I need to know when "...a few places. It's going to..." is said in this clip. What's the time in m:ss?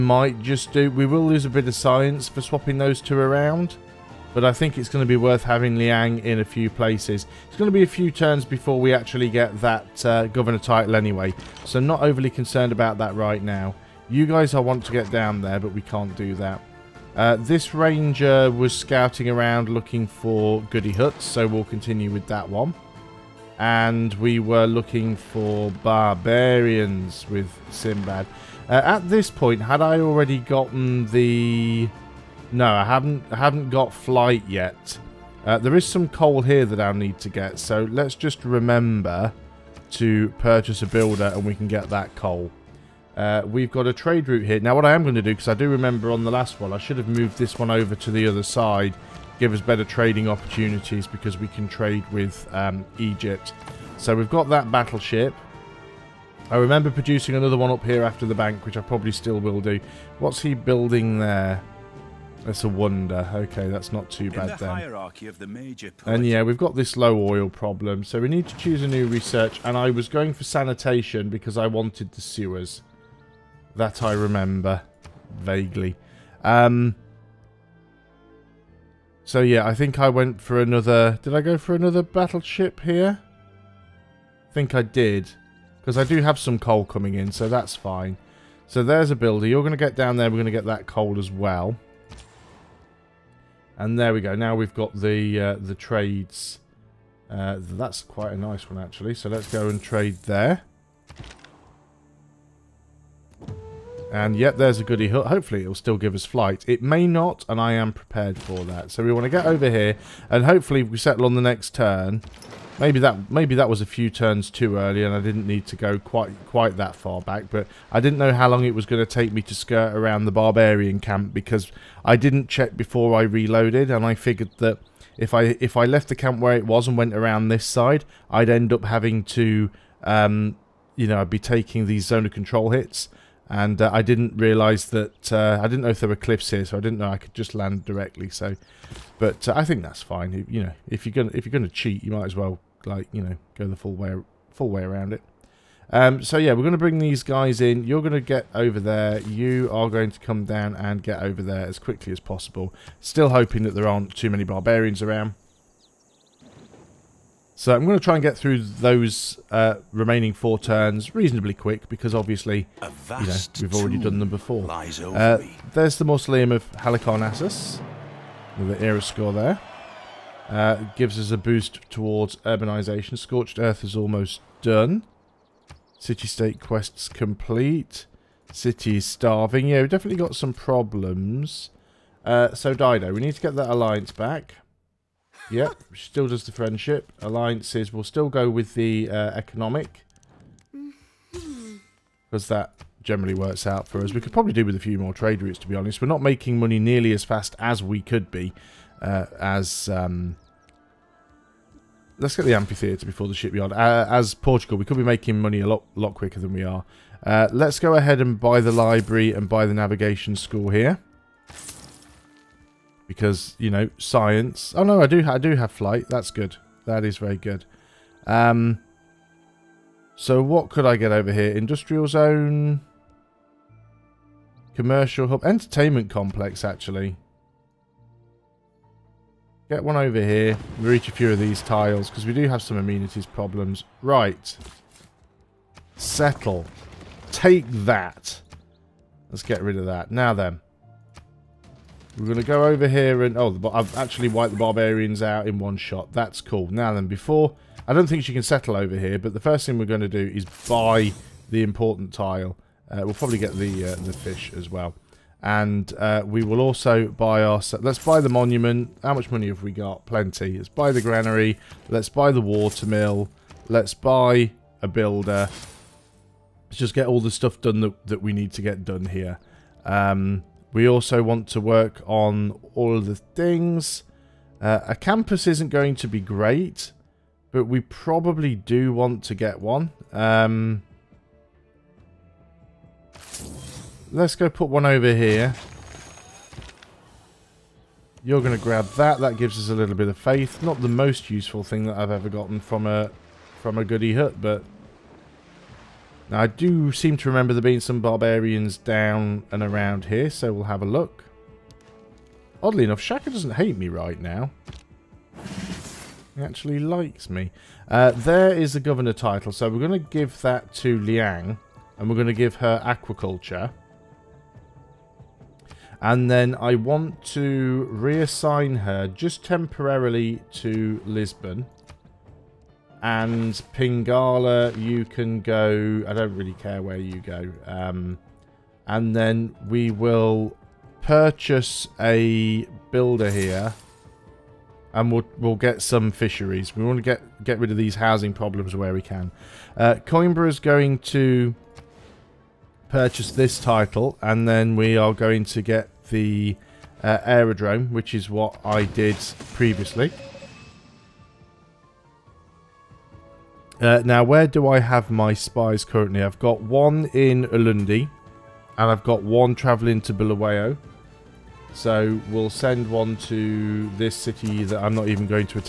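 0:06.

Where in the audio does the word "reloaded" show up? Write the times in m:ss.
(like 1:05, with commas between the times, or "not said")
2:03.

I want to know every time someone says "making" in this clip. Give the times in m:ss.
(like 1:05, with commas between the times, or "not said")
3:16, 3:25.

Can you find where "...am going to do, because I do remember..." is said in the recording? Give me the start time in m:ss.
0:44.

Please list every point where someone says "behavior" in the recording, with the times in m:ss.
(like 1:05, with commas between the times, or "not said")
not said.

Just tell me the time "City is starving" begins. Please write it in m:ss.
2:58.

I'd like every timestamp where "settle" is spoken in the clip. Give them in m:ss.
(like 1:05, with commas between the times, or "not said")
1:50, 3:55, 4:08.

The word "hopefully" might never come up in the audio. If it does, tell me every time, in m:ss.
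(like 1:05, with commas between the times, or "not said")
1:45, 1:50.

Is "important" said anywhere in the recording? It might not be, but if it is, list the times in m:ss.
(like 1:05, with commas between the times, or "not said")
4:11.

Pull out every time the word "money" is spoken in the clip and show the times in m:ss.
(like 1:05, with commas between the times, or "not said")
3:16, 3:25, 4:19.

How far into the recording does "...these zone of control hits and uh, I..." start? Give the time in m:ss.
2:11.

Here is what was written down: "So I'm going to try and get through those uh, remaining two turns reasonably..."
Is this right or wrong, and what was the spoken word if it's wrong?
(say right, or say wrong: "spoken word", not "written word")
wrong: "four", not "two".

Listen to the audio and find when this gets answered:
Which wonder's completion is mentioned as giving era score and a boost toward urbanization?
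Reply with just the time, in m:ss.
2:46.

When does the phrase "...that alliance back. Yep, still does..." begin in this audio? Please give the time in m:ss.
3:03.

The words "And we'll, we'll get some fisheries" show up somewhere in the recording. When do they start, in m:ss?
5:34.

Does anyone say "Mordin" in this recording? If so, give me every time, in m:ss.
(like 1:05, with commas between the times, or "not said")
not said.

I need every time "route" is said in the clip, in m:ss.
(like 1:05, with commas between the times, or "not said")
0:44, 3:15.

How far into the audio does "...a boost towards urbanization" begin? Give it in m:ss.
2:51.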